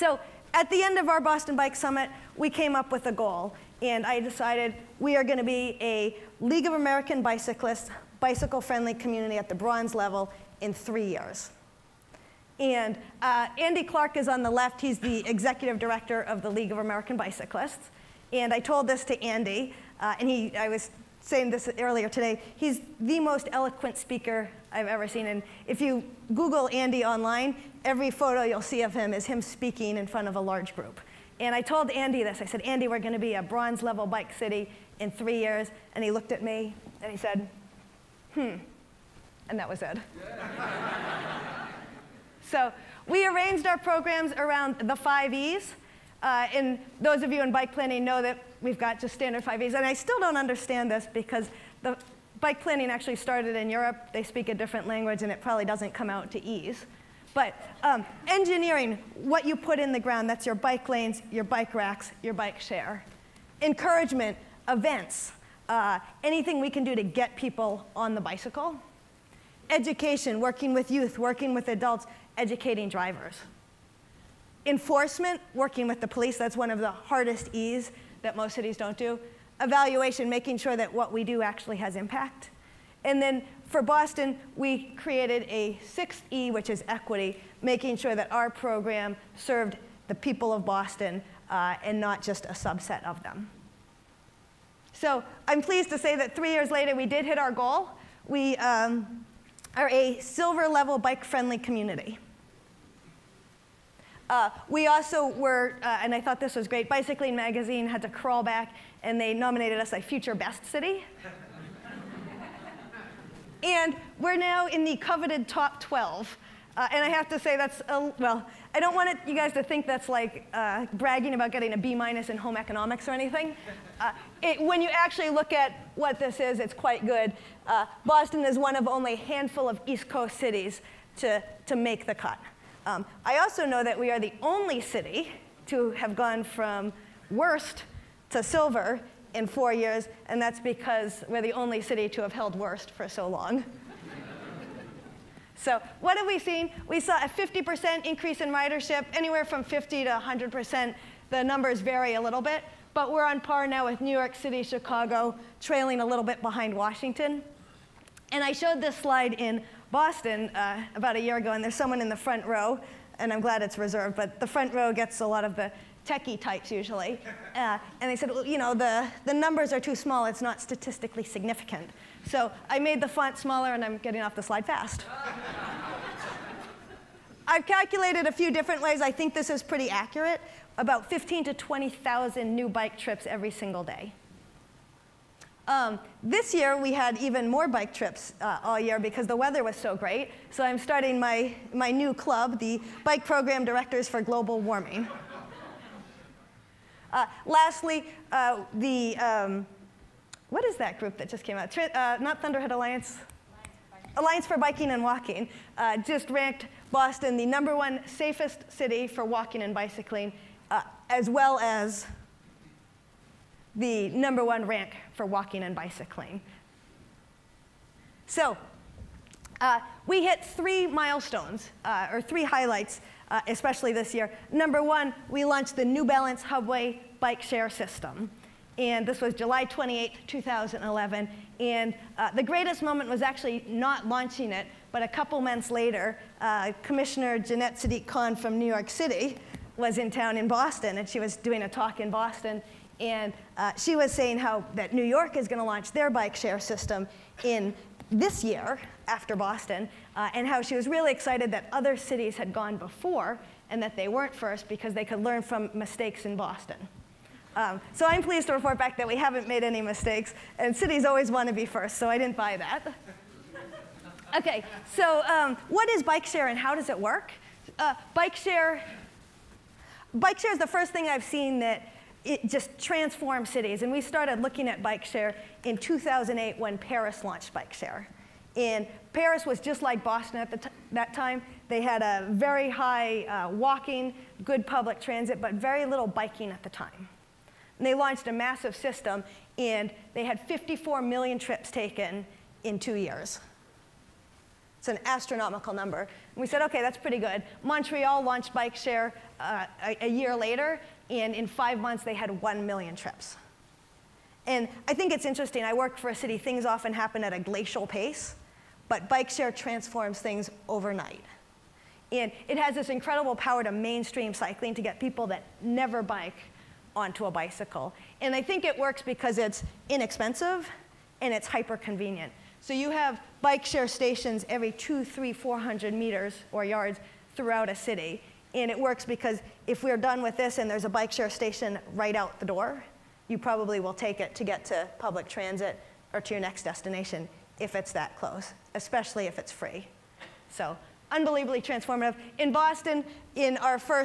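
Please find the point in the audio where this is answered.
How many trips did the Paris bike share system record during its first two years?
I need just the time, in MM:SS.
04:50.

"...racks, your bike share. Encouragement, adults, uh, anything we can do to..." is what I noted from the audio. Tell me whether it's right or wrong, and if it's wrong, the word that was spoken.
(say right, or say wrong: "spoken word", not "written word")
wrong: "events", not "adults".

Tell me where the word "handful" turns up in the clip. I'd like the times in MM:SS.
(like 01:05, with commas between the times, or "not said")
02:09.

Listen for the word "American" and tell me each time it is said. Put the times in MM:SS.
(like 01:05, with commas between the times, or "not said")
00:06, 00:16.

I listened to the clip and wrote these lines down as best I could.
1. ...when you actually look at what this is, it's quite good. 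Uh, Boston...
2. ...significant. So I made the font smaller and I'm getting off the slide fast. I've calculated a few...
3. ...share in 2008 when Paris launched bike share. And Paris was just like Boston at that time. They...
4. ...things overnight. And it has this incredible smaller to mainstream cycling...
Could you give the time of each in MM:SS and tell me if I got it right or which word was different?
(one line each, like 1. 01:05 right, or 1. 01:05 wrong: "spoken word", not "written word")
1. 02:04 right
2. 02:51 right
3. 04:35 right
4. 05:10 wrong: "power", not "smaller".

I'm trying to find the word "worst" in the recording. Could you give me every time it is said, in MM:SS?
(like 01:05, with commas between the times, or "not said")
02:17, 02:22.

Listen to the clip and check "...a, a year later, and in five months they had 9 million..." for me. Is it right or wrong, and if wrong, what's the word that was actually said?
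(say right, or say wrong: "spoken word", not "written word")
wrong: "1", not "9".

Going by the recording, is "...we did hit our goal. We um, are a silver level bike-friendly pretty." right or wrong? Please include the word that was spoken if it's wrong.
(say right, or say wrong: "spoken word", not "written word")
wrong: "community", not "pretty".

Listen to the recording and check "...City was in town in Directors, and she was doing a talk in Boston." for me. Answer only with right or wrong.
wrong.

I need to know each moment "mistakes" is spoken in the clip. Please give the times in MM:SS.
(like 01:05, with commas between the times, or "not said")
04:15, 04:19.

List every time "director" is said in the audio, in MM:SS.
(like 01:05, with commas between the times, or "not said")
00:15, 03:13.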